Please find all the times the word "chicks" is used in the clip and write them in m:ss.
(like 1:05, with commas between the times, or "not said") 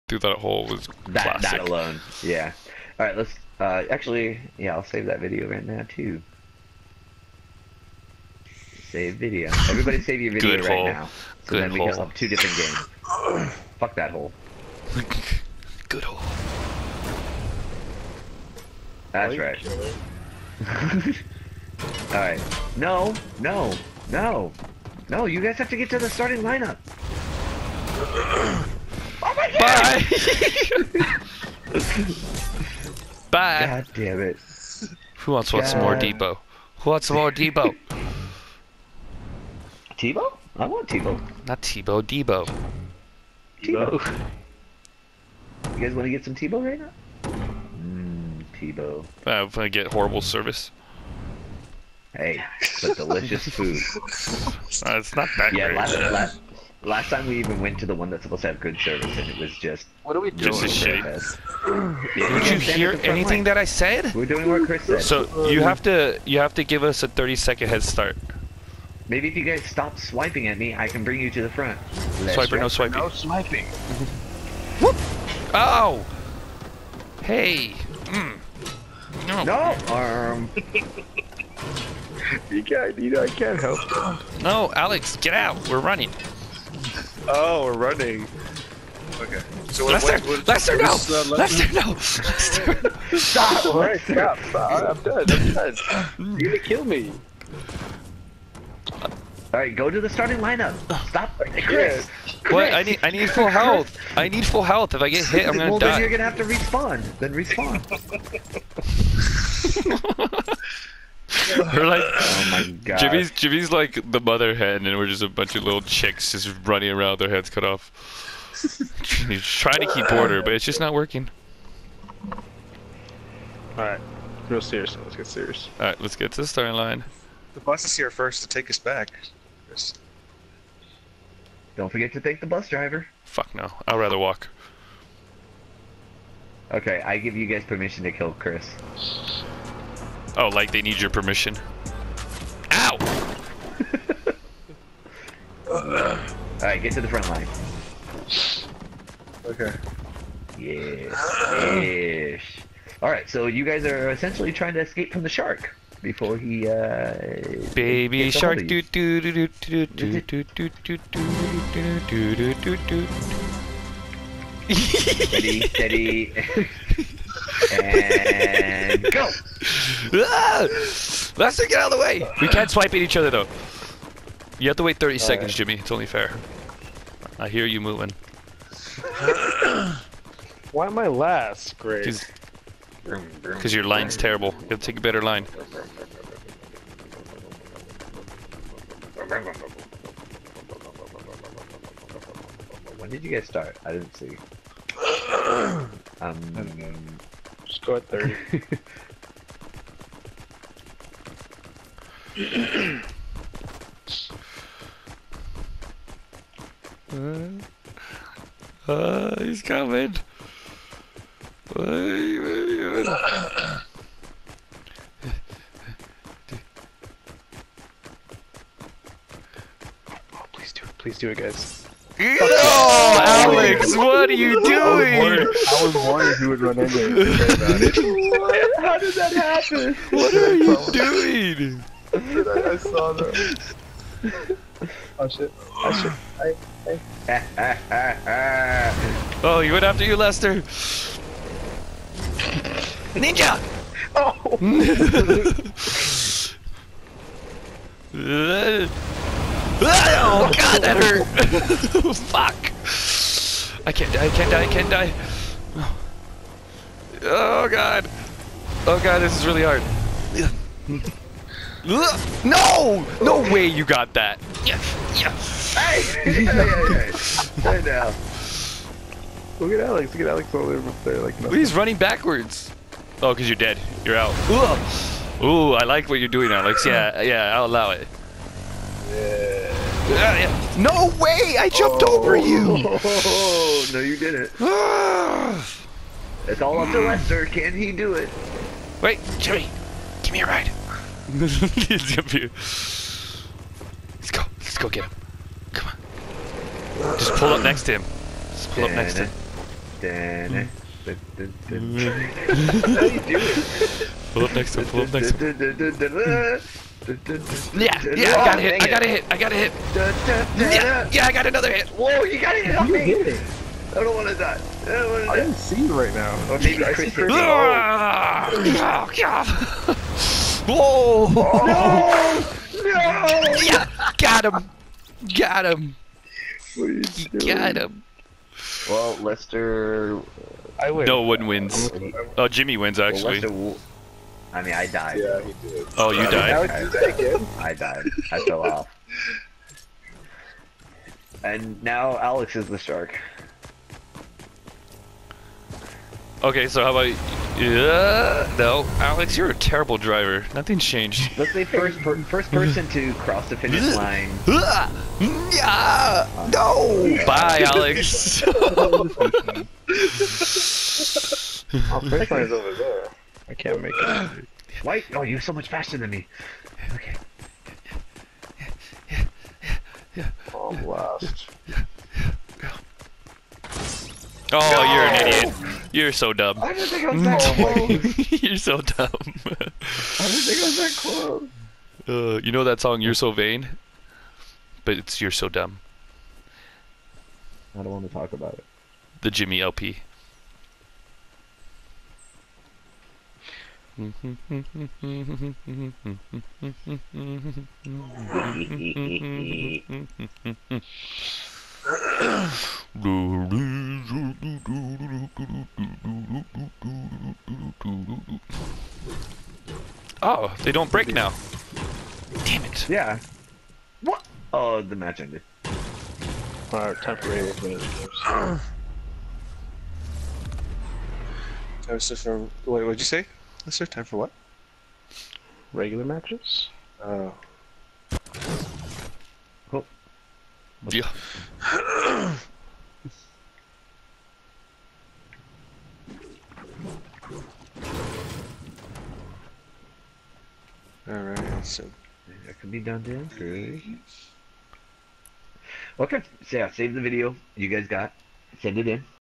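1:55.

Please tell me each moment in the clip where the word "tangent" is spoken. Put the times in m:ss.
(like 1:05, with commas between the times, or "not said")
not said.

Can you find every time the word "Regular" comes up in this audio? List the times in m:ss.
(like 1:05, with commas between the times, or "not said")
7:05.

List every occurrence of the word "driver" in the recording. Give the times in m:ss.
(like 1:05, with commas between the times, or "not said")
2:12, 5:49.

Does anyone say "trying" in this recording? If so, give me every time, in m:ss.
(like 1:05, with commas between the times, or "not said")
1:59, 2:34.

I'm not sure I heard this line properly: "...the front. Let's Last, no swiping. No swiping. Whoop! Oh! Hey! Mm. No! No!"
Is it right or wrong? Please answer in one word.
wrong.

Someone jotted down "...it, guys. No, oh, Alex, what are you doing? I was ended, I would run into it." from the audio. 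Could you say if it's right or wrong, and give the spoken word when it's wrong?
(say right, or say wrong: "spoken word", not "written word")
wrong: "worried", not "ended".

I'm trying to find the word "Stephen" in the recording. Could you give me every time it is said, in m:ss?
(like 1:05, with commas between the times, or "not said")
not said.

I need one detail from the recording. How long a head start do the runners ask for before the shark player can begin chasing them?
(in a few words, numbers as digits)
30 seconds.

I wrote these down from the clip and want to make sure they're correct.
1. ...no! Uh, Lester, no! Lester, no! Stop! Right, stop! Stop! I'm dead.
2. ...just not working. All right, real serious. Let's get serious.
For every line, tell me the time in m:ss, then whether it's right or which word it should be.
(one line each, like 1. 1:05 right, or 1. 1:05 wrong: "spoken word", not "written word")
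1. 1:30 right
2. 2:00 right.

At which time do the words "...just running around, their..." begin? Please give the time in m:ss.
1:56.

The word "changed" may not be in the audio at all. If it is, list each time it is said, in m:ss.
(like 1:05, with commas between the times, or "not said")
5:50.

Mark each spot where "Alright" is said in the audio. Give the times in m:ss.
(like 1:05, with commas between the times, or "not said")
2:25, 2:33, 7:21.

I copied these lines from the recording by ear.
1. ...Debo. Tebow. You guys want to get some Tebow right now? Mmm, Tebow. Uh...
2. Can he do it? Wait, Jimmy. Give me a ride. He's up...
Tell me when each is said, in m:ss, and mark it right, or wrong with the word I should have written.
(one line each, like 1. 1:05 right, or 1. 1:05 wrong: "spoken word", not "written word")
1. 0:42 right
2. 4:47 right.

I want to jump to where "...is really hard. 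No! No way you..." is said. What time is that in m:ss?
4:19.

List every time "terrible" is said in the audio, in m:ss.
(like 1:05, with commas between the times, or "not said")
3:04, 5:49.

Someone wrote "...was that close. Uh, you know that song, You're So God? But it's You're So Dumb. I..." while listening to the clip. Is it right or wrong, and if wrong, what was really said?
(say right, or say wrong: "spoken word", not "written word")
wrong: "Vain", not "God".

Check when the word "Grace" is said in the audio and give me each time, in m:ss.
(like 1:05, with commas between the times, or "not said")
3:01.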